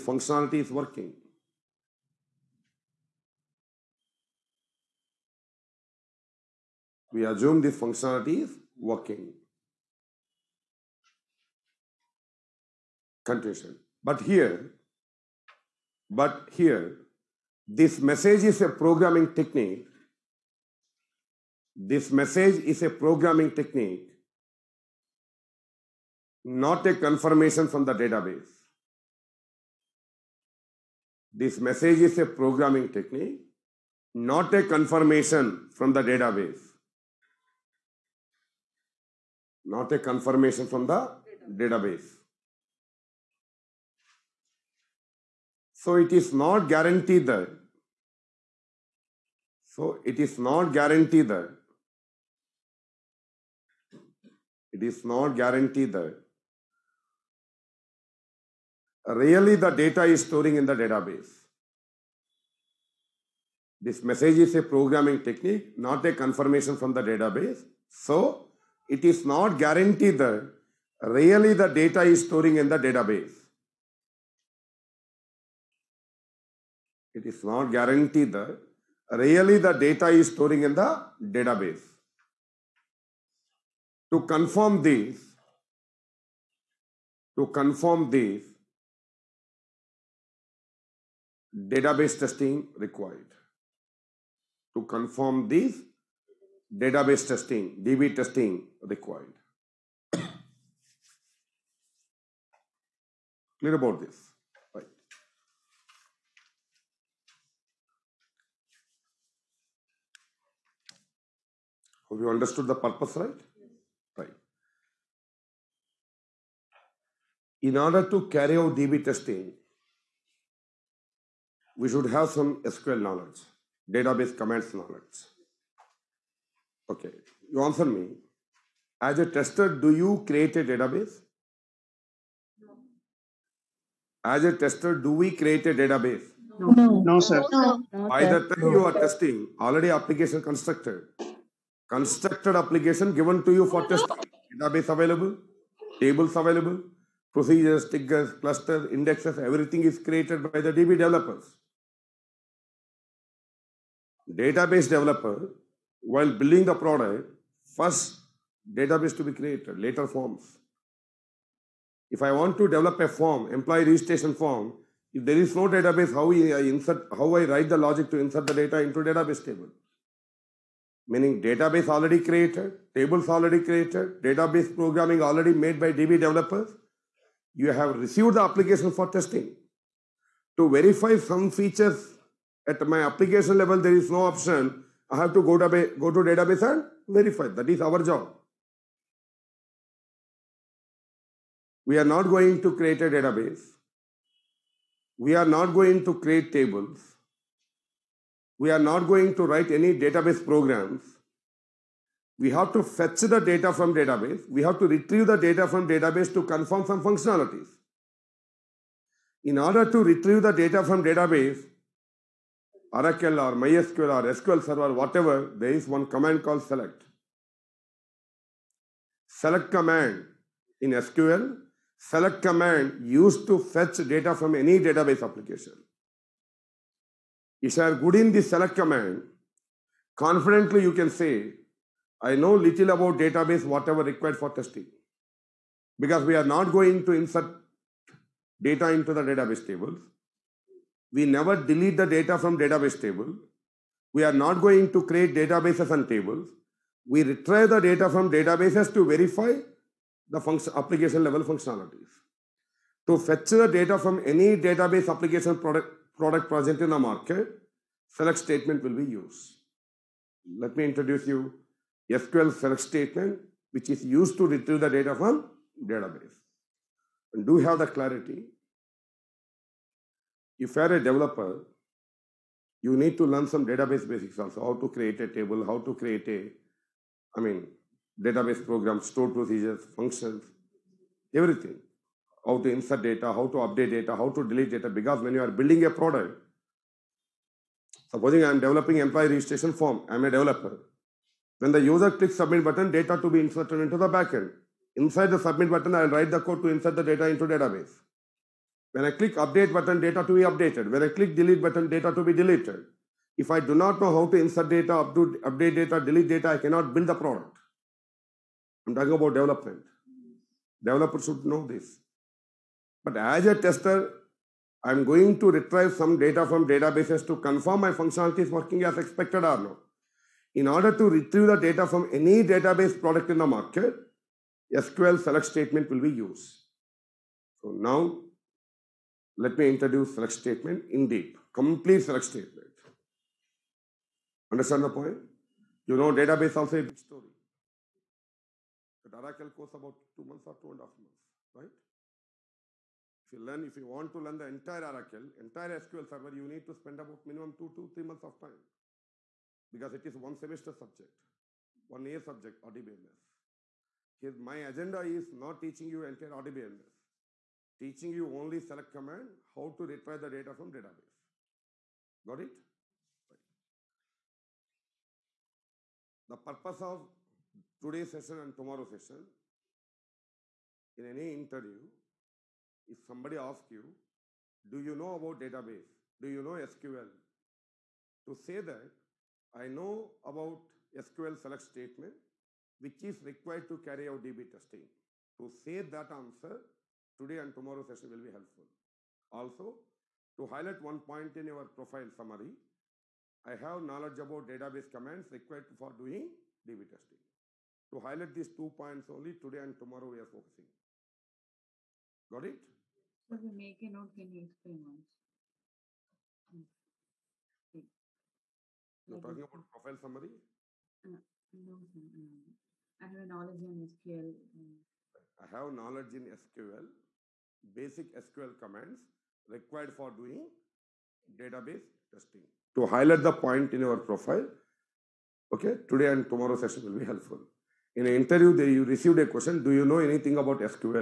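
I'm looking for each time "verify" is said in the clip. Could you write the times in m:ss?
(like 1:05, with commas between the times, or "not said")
3:00, 3:07, 4:09.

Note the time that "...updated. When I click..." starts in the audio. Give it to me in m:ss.
5:00.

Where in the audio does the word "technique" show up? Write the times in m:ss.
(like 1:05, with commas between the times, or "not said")
0:19, 0:23, 0:32, 1:05.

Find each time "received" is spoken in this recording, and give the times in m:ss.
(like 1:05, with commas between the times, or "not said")
2:57, 7:08.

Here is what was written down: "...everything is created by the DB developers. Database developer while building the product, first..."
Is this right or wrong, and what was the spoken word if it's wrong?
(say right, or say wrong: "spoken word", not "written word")
right.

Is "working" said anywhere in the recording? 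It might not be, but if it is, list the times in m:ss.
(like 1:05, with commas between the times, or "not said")
0:00, 0:08, 5:18.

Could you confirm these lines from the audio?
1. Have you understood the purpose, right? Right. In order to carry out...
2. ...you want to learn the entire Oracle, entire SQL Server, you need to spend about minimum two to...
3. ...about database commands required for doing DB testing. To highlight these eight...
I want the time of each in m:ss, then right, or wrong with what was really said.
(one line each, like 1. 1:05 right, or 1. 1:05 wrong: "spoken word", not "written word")
1. 1:52 right
2. 5:43 right
3. 6:34 wrong: "two", not "eight".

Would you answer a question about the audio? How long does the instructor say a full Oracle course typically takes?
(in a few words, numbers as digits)
two months or two and a half months.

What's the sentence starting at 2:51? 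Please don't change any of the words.
Meaning database already created, tables already created, database programming already made by DB developers.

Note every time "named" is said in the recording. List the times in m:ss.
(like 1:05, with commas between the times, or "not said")
not said.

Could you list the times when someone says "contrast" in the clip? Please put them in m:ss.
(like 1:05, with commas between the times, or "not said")
not said.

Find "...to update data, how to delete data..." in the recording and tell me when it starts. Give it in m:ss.
4:43.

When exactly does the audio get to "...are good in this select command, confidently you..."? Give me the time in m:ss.
3:47.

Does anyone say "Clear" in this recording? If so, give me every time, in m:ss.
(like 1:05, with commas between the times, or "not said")
1:43.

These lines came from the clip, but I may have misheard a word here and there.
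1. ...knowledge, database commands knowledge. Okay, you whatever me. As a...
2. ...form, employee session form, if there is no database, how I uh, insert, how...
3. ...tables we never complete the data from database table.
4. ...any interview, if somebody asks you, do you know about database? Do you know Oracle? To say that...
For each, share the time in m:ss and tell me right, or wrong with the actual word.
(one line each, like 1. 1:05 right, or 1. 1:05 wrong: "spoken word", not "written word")
1. 2:03 wrong: "answer", not "whatever"
2. 2:43 wrong: "registration", not "session"
3. 3:59 wrong: "delete", not "complete"
4. 6:11 wrong: "SQL", not "Oracle".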